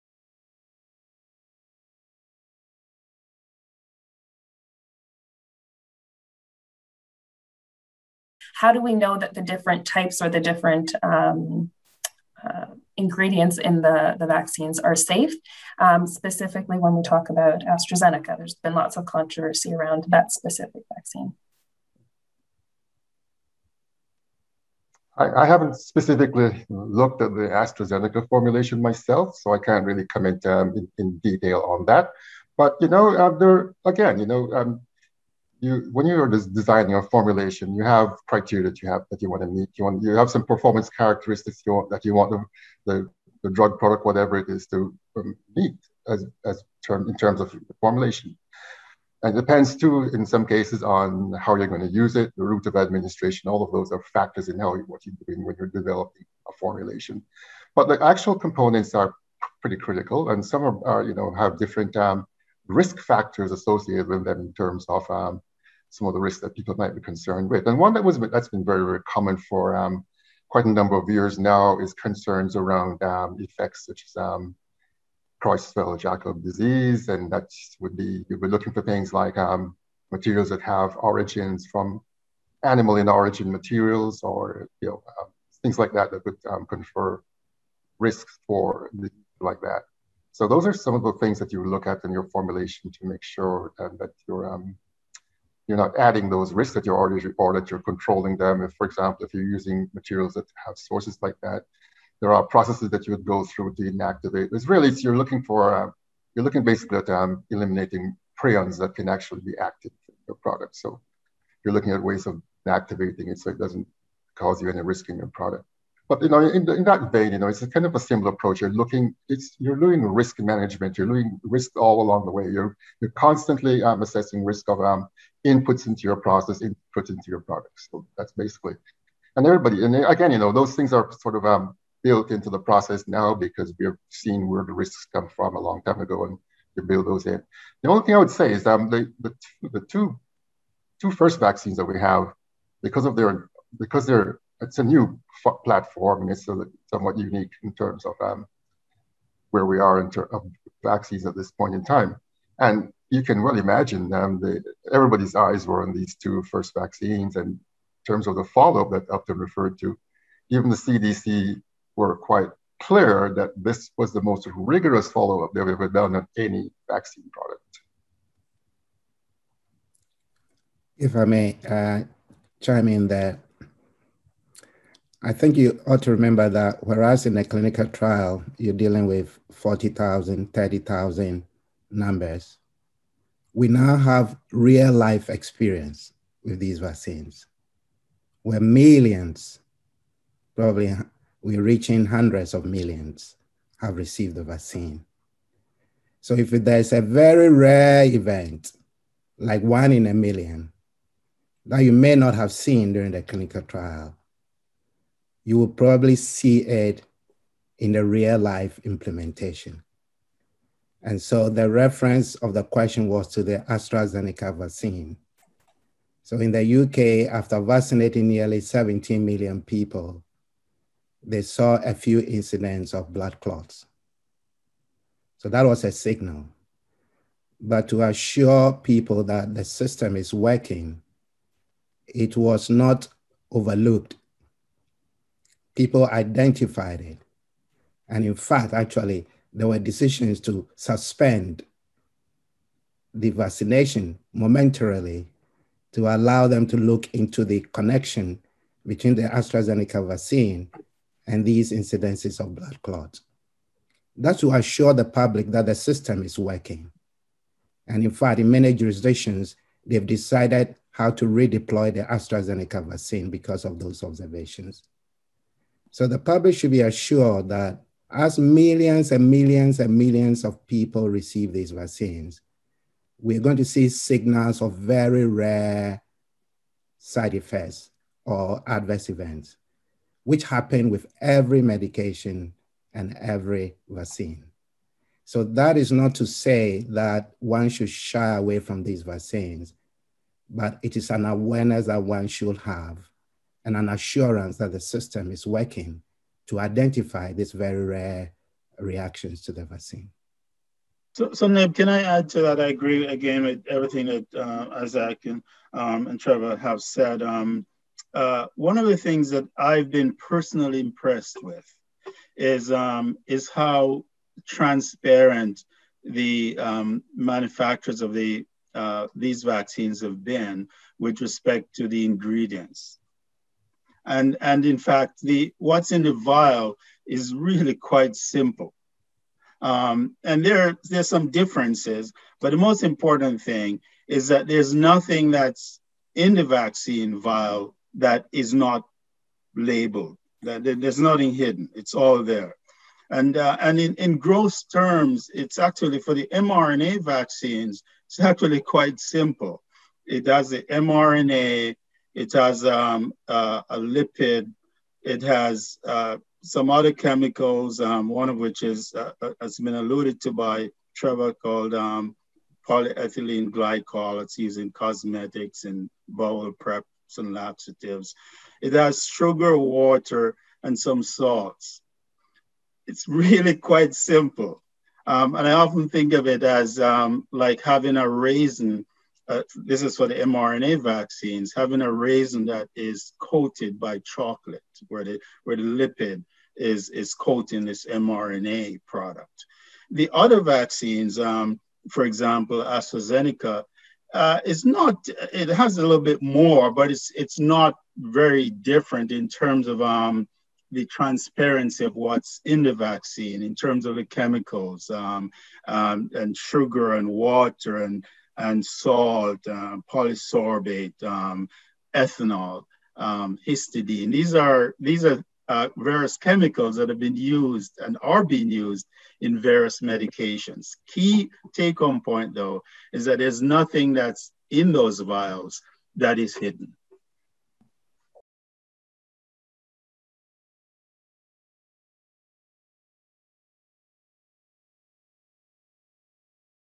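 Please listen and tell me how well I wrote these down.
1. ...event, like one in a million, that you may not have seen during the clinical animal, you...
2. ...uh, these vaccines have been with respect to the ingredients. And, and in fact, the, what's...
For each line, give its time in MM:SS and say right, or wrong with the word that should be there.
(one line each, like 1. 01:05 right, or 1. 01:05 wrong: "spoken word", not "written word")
1. 03:18 wrong: "trial", not "animal"
2. 05:18 right.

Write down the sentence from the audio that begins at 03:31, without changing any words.
And so the reference of the question was to the AstraZeneca vaccine.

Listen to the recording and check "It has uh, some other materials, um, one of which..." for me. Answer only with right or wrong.
wrong.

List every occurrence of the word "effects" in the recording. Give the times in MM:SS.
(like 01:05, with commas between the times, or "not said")
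01:13, 04:37.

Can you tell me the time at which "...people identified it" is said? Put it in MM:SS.
03:55.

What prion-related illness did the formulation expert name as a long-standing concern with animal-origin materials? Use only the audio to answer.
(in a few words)
Creutzfeldt disease.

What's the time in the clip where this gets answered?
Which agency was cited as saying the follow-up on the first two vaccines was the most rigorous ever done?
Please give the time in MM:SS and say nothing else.
02:40.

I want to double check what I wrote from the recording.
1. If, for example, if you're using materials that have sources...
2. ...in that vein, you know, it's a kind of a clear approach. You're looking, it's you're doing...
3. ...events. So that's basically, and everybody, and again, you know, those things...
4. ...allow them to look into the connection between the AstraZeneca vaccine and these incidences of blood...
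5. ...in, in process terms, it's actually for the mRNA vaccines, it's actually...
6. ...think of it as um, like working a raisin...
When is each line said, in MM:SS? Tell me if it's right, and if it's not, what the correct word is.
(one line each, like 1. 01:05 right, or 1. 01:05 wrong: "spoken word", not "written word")
1. 01:38 right
2. 01:56 wrong: "similar", not "clear"
3. 02:07 wrong: "products", not "events"
4. 04:06 right
5. 05:43 wrong: "gross", not "process"
6. 06:15 wrong: "having", not "working".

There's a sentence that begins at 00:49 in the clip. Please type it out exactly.
And it depends too, in some cases, on how you're going to use it, the route of administration.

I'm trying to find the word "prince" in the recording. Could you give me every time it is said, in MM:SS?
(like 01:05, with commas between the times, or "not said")
not said.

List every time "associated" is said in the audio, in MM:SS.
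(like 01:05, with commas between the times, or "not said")
01:03.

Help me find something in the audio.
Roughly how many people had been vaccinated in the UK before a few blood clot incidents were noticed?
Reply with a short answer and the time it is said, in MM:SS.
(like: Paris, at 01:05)
17 million, at 03:38.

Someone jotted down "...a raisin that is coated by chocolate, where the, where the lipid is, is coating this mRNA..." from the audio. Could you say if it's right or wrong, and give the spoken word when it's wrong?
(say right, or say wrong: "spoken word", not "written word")
right.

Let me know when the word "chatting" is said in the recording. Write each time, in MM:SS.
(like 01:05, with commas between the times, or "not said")
not said.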